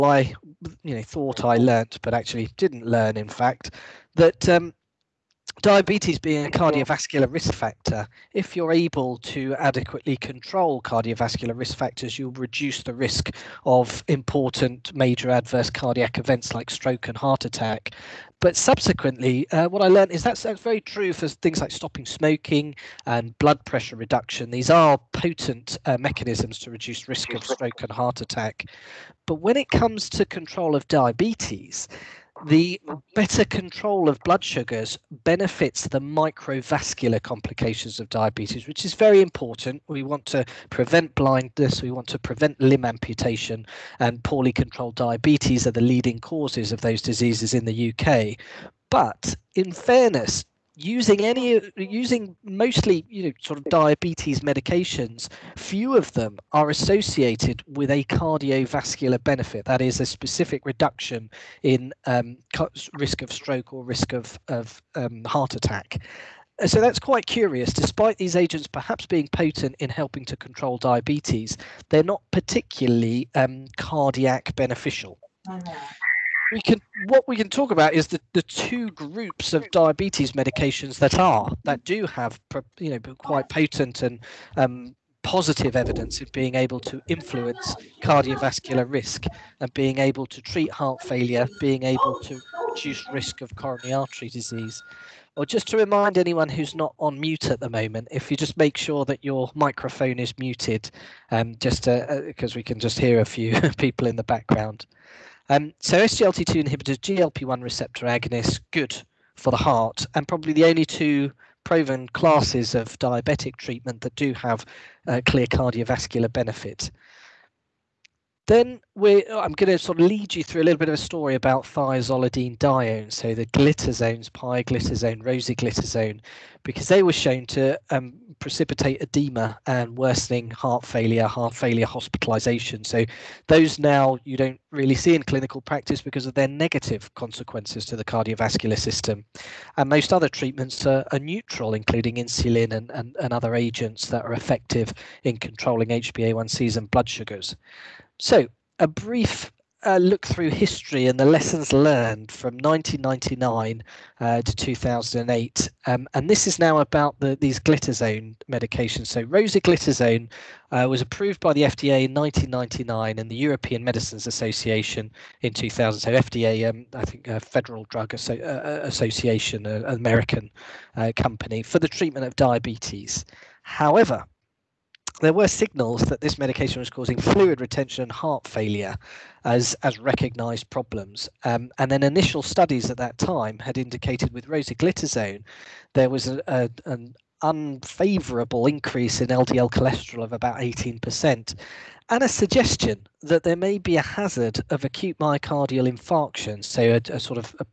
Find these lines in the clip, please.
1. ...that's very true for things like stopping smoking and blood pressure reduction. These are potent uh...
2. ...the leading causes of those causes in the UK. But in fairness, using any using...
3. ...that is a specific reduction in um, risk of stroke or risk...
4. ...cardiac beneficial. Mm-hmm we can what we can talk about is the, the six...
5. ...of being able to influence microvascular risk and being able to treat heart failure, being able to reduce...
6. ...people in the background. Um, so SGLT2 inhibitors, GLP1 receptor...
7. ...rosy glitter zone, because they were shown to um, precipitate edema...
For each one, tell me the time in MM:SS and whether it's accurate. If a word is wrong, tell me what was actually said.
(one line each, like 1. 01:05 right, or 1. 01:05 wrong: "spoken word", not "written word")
1. 00:20 right
2. 00:45 wrong: "diseases", not "causes"
3. 00:59 right
4. 01:13 wrong: "two", not "six"
5. 01:26 wrong: "cardiovascular", not "microvascular"
6. 01:43 right
7. 02:05 right.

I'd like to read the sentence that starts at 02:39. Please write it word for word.
So, rosiglitazone uh, was approved by the FDA in 1999 and the European Medicines Association in 2000.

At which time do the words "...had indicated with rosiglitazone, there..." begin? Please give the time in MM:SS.
03:03.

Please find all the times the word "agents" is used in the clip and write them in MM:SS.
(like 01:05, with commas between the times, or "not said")
01:08, 02:23.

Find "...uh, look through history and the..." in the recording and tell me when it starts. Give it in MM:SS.
02:29.